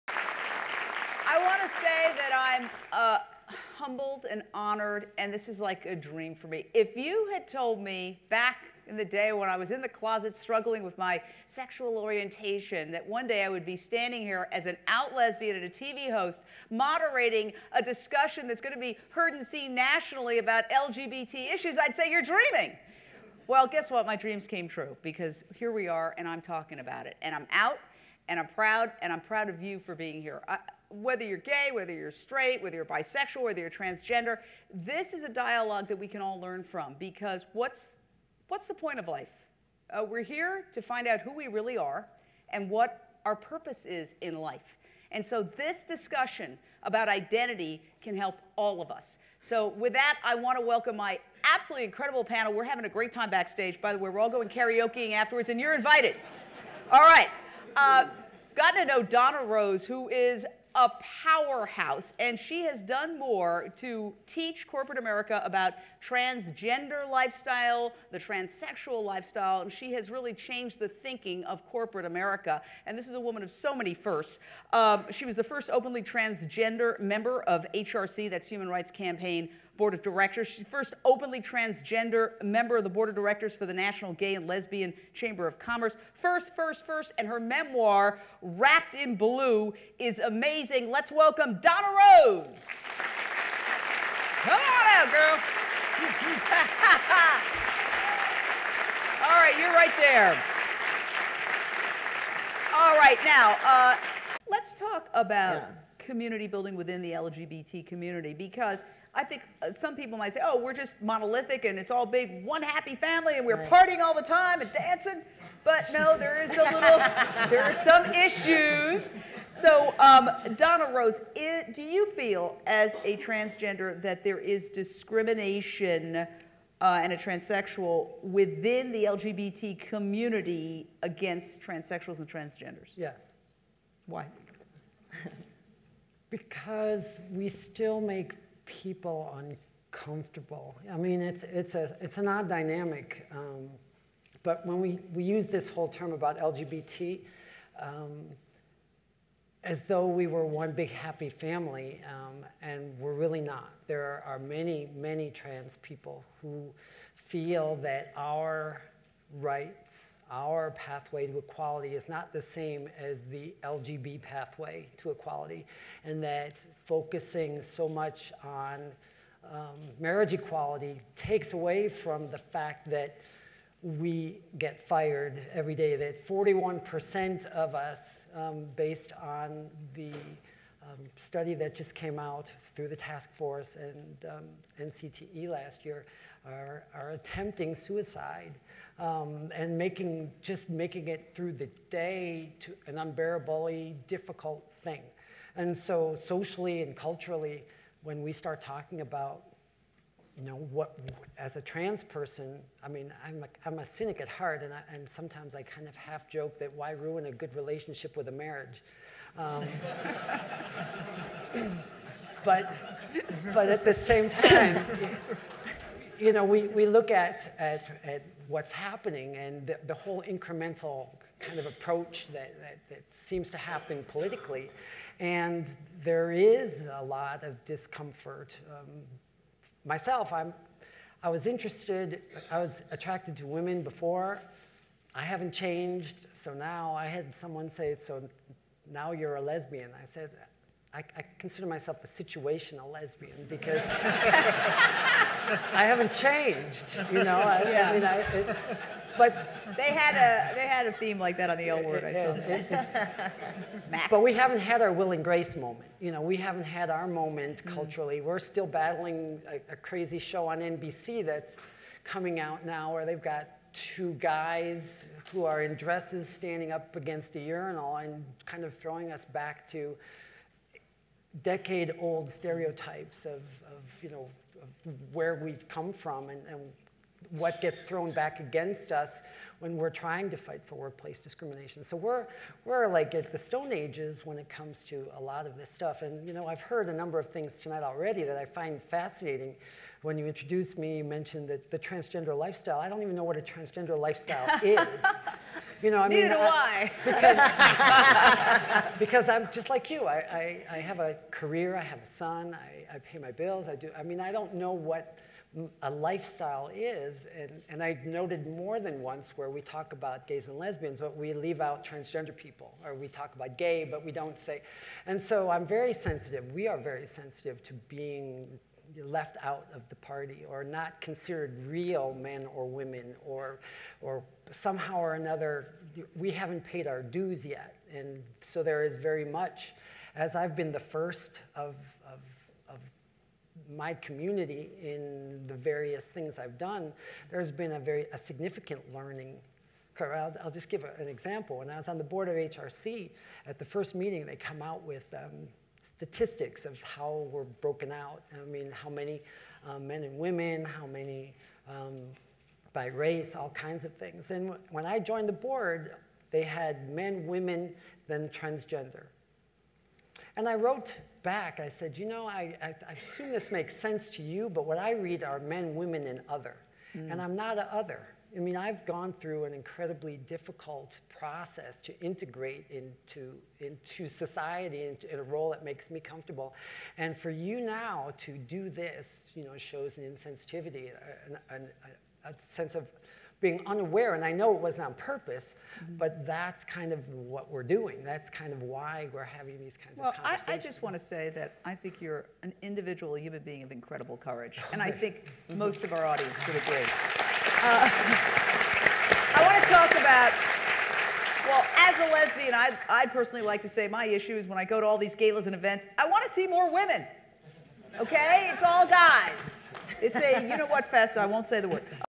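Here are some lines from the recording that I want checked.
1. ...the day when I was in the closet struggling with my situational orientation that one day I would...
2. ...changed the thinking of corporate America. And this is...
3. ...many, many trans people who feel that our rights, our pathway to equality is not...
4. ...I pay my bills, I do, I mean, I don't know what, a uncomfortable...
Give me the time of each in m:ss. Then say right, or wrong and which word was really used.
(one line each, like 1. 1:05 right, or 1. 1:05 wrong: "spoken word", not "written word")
1. 0:08 wrong: "sexual", not "situational"
2. 1:10 right
3. 2:34 right
4. 5:02 wrong: "lifestyle", not "uncomfortable".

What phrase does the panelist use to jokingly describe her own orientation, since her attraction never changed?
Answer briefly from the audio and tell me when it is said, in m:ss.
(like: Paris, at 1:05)
situational lesbian, at 4:02.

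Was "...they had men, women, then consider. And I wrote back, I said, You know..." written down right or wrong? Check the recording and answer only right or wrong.
wrong.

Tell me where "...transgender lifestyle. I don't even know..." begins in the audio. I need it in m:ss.
4:51.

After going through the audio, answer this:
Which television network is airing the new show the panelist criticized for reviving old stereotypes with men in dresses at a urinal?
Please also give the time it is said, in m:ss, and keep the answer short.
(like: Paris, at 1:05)
NBC, at 4:20.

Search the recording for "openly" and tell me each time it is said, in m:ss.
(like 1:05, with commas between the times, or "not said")
1:15, 1:21.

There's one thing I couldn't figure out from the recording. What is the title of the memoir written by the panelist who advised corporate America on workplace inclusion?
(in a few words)
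Wrapped in Blue.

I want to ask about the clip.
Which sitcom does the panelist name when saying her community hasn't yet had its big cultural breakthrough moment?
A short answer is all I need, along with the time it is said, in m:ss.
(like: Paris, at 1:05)
Will and Grace, at 4:14.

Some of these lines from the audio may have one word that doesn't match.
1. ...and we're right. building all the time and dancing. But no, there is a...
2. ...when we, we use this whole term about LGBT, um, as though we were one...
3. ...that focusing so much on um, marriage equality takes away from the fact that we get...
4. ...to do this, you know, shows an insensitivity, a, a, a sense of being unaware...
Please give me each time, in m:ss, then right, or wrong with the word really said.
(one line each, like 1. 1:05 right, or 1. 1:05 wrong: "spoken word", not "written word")
1. 1:53 wrong: "partying", not "building"
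2. 2:24 right
3. 2:46 right
4. 6:18 right.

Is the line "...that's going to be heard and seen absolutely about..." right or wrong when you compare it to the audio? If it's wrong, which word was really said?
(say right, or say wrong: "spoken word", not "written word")
wrong: "nationally", not "absolutely".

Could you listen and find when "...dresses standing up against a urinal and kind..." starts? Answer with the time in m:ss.
4:25.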